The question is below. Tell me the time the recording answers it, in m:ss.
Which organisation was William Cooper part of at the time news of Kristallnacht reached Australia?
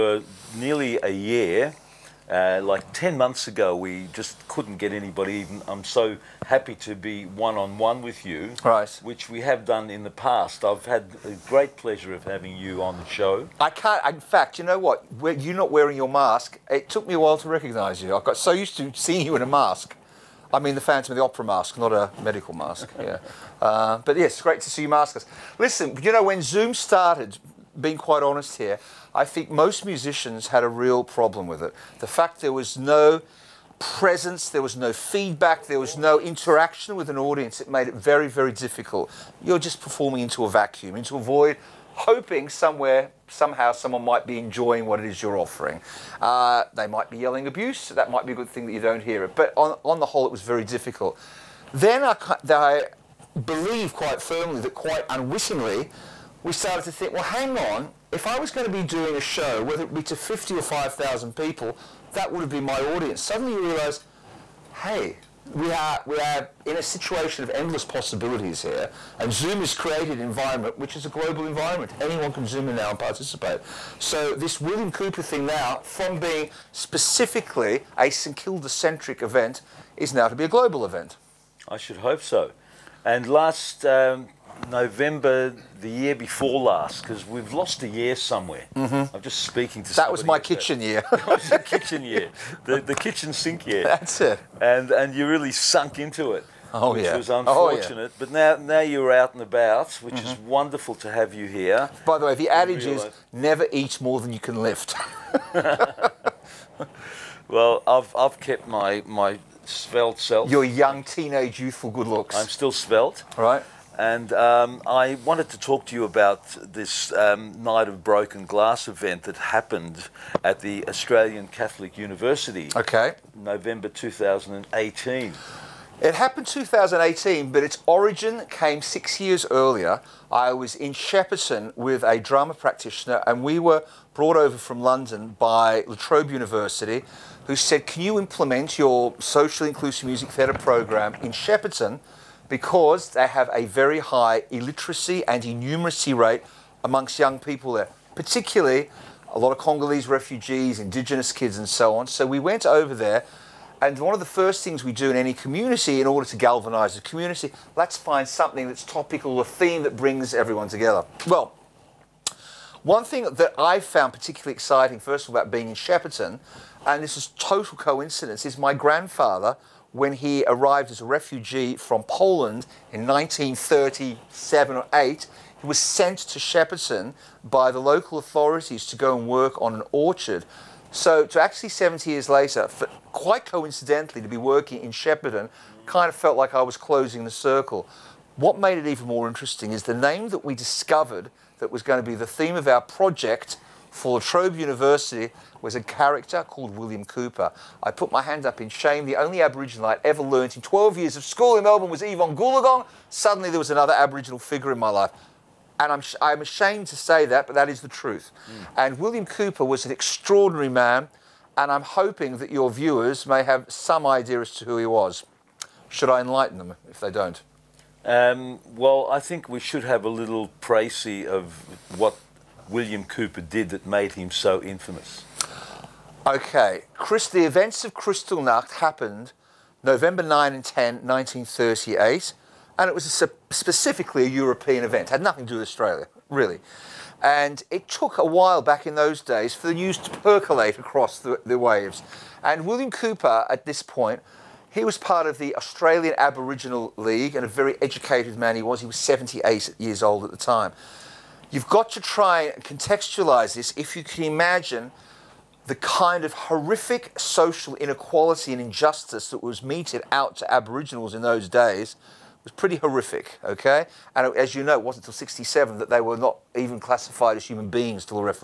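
4:05.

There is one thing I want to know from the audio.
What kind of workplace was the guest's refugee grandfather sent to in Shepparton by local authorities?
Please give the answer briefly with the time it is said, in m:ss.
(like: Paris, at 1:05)
Orchard, at 2:59.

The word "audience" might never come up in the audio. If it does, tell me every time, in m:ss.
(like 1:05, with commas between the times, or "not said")
0:37, 1:02.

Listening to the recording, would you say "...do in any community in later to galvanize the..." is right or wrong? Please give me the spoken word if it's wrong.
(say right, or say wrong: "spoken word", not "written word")
wrong: "order", not "later".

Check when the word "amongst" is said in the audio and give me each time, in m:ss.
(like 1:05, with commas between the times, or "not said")
2:26.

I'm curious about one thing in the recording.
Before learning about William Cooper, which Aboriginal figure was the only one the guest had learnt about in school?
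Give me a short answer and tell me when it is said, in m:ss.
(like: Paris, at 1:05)
Evonne Goolagong, at 3:22.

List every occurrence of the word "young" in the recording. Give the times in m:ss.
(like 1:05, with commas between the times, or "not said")
1:50, 2:27.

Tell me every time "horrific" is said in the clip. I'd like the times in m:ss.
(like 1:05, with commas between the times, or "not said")
4:16, 4:22.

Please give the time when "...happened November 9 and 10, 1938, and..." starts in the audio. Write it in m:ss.
3:48.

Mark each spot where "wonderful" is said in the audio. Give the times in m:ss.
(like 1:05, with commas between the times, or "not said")
1:40.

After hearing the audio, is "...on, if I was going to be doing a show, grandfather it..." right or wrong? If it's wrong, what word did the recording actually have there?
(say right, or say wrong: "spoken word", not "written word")
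wrong: "whether", not "grandfather".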